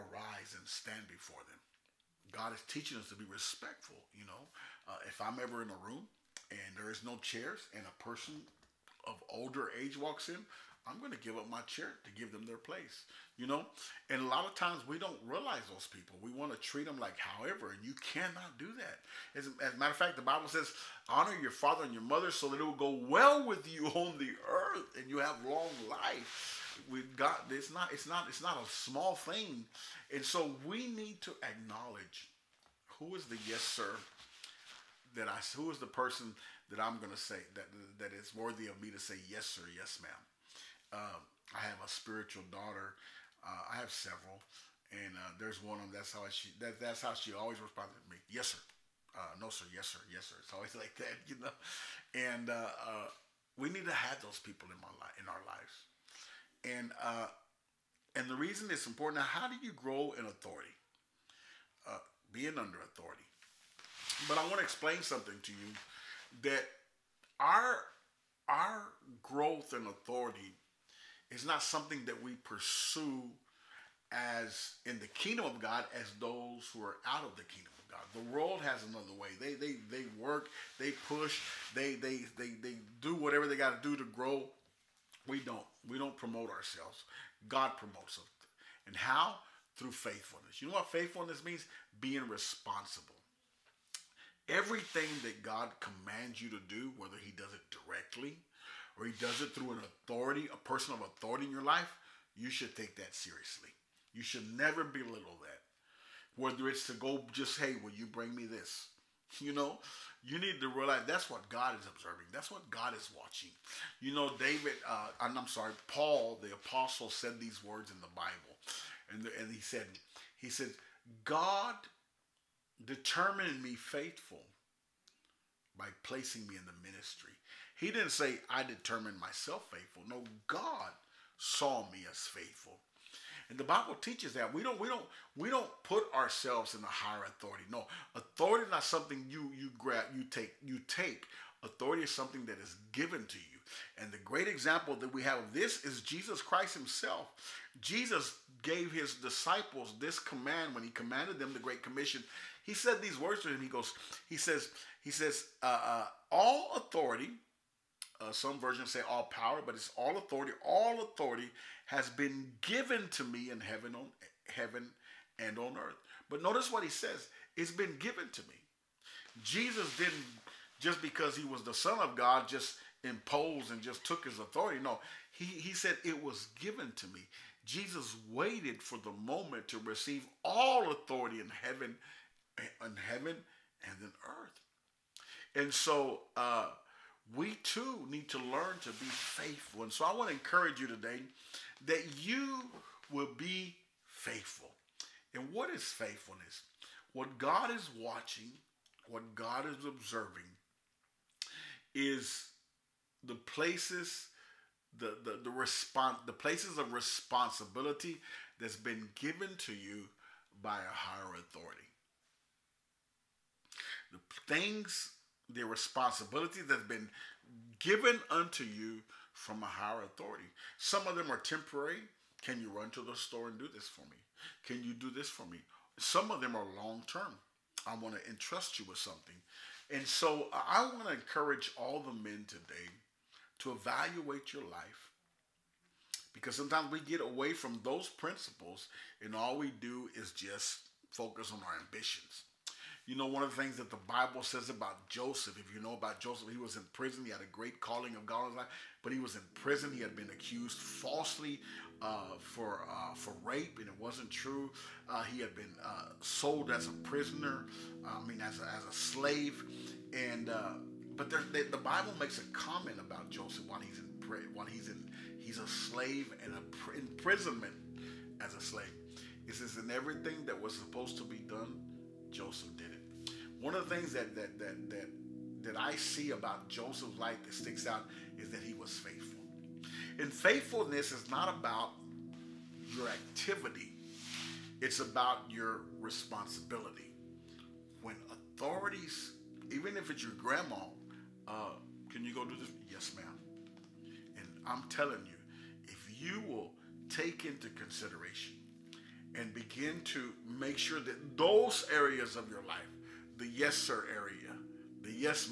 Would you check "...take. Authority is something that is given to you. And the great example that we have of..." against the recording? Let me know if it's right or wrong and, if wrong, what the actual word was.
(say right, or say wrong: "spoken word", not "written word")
right.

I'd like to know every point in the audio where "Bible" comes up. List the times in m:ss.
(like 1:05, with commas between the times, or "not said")
0:20, 1:58, 2:13, 4:04, 4:21.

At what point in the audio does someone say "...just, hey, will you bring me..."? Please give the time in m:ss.
1:47.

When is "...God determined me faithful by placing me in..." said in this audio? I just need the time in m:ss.
2:01.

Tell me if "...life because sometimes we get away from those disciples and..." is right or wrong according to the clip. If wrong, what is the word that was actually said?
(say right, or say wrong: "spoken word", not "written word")
wrong: "principles", not "disciples".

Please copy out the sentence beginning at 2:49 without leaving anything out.
Jesus didn't just because he was the son of God just imposed and just took his authority.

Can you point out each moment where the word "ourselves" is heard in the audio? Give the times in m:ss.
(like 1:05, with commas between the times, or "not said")
1:26, 2:16.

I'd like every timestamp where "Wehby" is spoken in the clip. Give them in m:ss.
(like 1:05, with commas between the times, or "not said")
not said.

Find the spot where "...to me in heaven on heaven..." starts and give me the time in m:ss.
2:43.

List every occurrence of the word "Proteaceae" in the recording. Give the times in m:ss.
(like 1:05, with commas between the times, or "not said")
not said.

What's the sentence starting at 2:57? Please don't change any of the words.
Jesus waited for the moment to receive all authority in heaven, in heaven and in earth.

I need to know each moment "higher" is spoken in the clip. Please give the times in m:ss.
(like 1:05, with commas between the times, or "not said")
2:16, 3:30, 3:39.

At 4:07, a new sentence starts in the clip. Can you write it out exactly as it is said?
He had a great calling of God in his life, but he was in prison.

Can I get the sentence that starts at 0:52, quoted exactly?
And uh, uh, we need to have those people in my life in our lives.